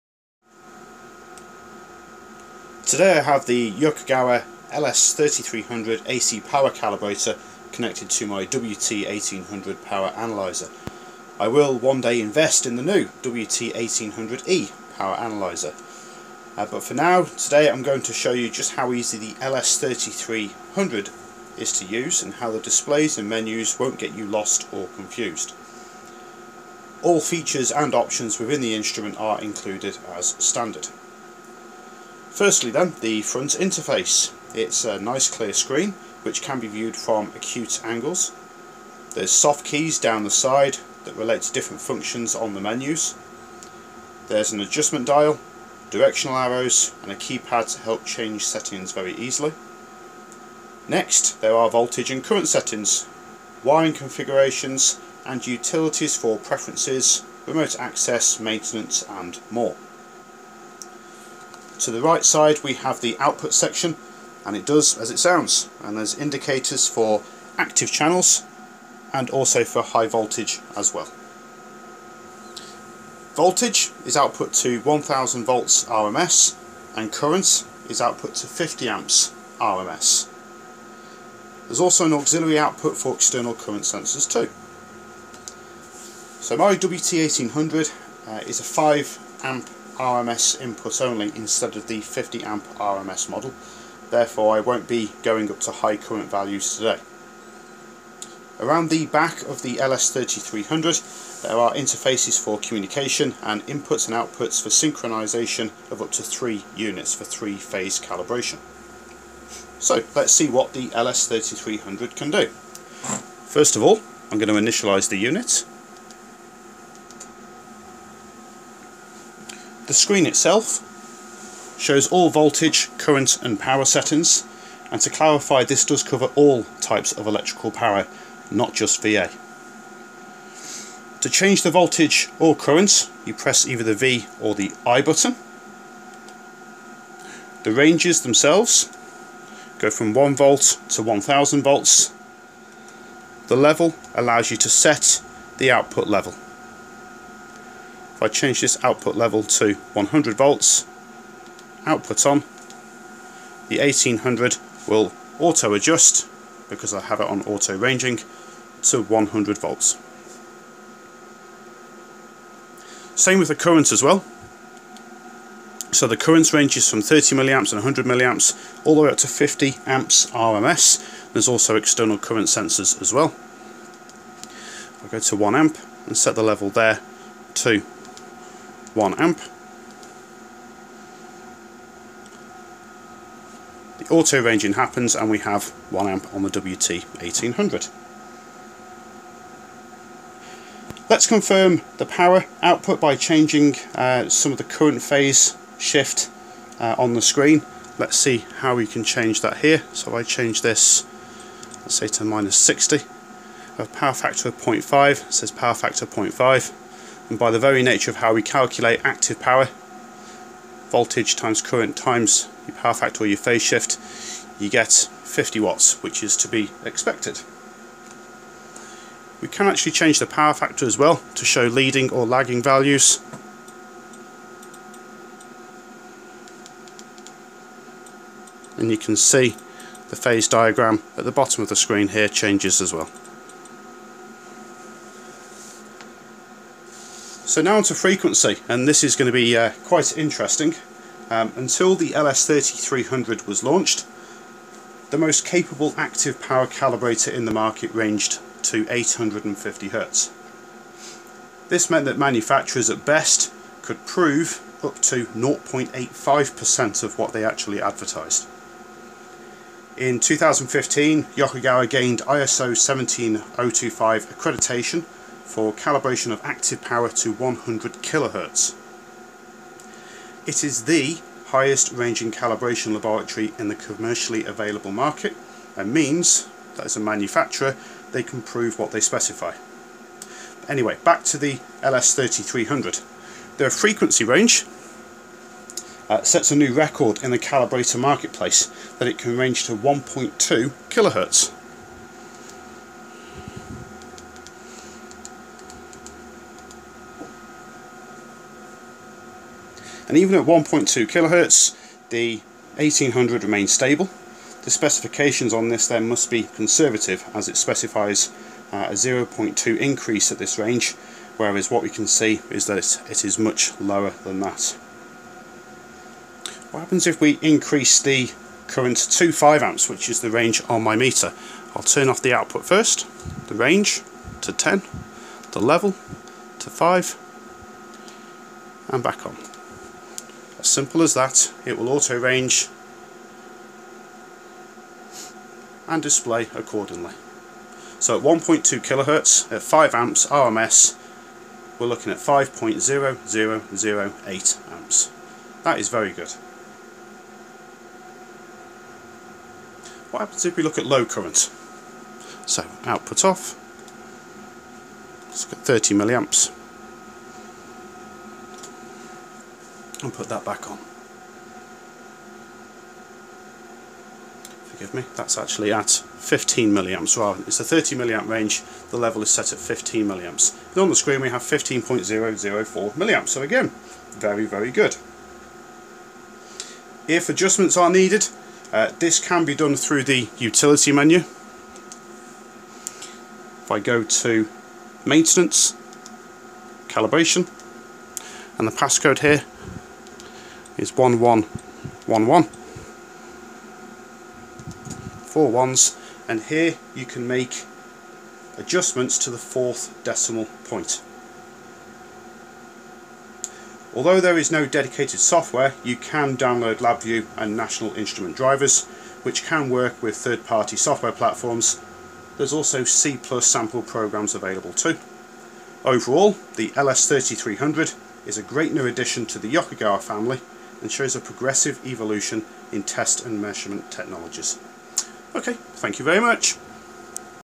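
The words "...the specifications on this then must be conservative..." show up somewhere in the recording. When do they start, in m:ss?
5:04.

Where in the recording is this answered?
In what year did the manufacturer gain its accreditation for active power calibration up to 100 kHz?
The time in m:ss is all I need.
4:20.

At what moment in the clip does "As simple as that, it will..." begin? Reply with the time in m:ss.
5:30.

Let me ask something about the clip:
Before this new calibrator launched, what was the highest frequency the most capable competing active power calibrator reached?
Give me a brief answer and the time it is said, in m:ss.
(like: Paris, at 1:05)
850 Hz, at 4:08.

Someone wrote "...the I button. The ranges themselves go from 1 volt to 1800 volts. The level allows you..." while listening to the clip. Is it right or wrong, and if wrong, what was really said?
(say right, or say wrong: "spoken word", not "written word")
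wrong: "1000", not "1800".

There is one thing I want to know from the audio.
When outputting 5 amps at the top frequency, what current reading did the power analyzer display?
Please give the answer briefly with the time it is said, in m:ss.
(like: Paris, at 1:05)
5.0008 amps, at 5:42.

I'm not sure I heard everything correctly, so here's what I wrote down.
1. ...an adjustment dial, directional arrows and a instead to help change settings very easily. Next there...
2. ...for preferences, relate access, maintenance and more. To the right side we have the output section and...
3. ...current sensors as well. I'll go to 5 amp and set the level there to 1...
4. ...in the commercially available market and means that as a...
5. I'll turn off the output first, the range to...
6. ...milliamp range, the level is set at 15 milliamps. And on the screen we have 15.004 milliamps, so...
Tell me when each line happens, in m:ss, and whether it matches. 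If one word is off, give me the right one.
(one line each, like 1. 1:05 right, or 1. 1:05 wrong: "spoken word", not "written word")
1. 0:44 wrong: "keypad", not "instead"
2. 0:56 wrong: "remote", not "relate"
3. 2:52 wrong: "1", not "5"
4. 4:33 right
5. 5:21 right
6. 6:07 right.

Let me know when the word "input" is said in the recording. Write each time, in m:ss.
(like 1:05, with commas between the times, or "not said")
1:30, 1:43.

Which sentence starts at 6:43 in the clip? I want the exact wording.
Although there is no dedicated software, you can download LabVIEW and National Instrument drivers, which can work with third-party software platforms.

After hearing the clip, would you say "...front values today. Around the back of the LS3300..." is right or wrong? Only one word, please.
wrong.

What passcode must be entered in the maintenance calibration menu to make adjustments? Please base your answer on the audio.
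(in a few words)
1111.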